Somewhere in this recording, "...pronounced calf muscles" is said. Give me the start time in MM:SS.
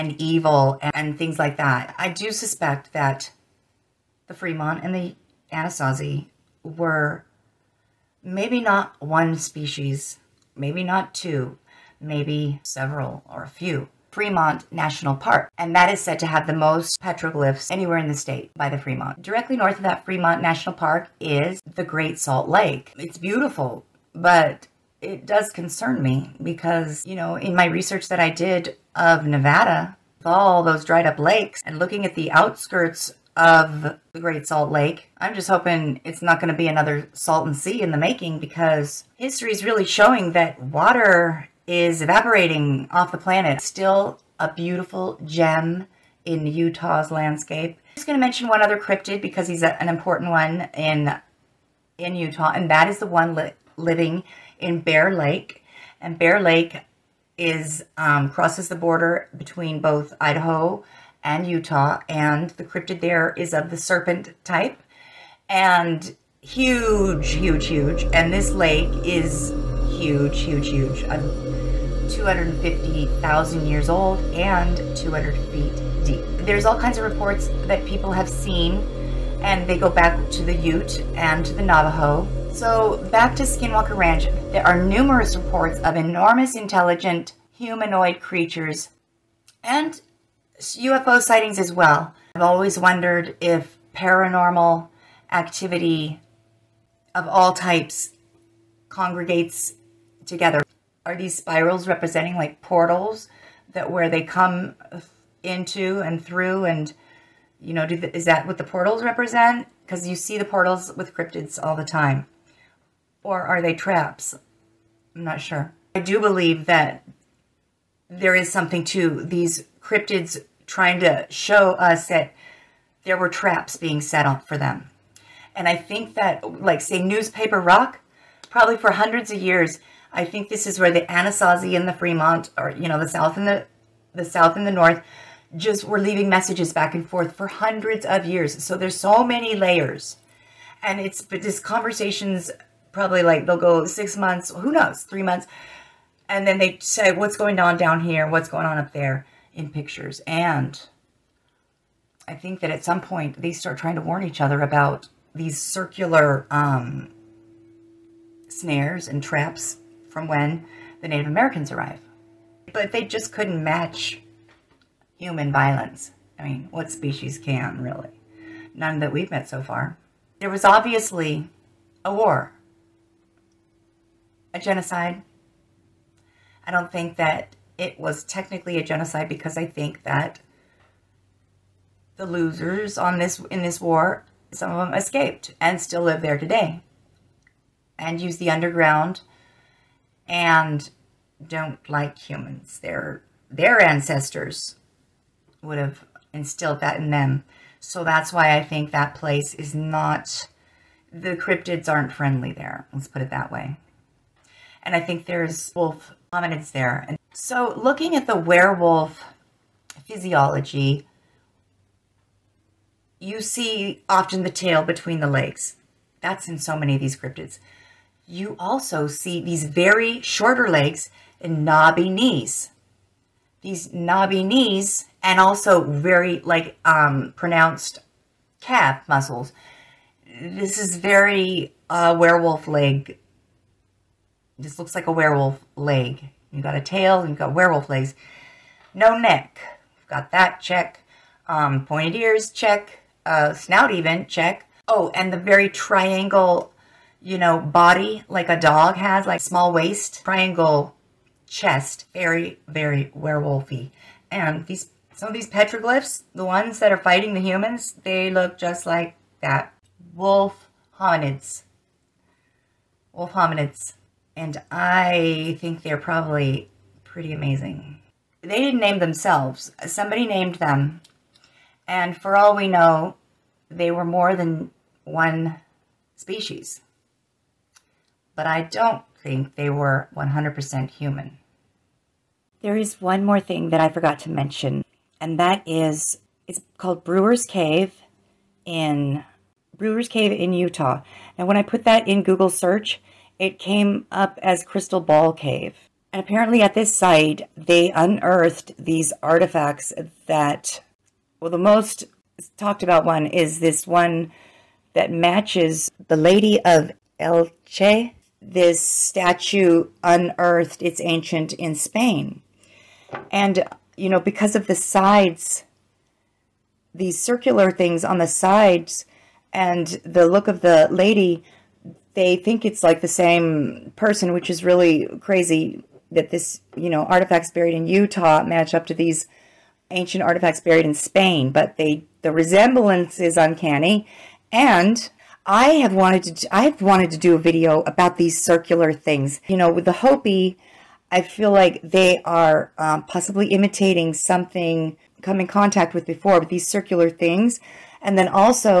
03:47.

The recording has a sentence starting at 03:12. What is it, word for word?
Their their ancestors would have instilled that in them.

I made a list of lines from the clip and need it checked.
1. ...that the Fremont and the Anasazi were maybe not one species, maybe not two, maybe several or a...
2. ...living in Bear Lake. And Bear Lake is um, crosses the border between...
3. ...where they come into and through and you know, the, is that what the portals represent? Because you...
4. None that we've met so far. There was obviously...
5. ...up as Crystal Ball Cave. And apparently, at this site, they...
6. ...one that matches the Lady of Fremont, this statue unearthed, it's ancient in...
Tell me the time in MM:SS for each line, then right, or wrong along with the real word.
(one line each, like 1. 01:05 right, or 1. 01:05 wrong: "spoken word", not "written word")
1. 00:02 right
2. 00:53 right
3. 01:43 right
4. 02:48 right
5. 04:54 right
6. 05:03 wrong: "Elche", not "Fremont".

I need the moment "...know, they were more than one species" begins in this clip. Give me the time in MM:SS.
04:32.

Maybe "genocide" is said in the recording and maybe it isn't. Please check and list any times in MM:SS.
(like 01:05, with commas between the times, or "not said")
02:54, 02:58.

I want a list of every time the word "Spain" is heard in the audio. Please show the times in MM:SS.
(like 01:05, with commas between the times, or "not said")
05:11, 05:30.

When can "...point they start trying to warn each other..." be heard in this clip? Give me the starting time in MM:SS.
02:33.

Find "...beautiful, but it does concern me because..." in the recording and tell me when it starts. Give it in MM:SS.
00:23.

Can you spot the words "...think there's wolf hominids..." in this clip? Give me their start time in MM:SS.
03:24.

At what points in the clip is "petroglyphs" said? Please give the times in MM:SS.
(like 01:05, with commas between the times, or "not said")
00:17, 04:15.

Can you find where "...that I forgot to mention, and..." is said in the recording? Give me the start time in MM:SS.
04:43.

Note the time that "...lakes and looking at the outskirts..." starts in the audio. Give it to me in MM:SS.
00:31.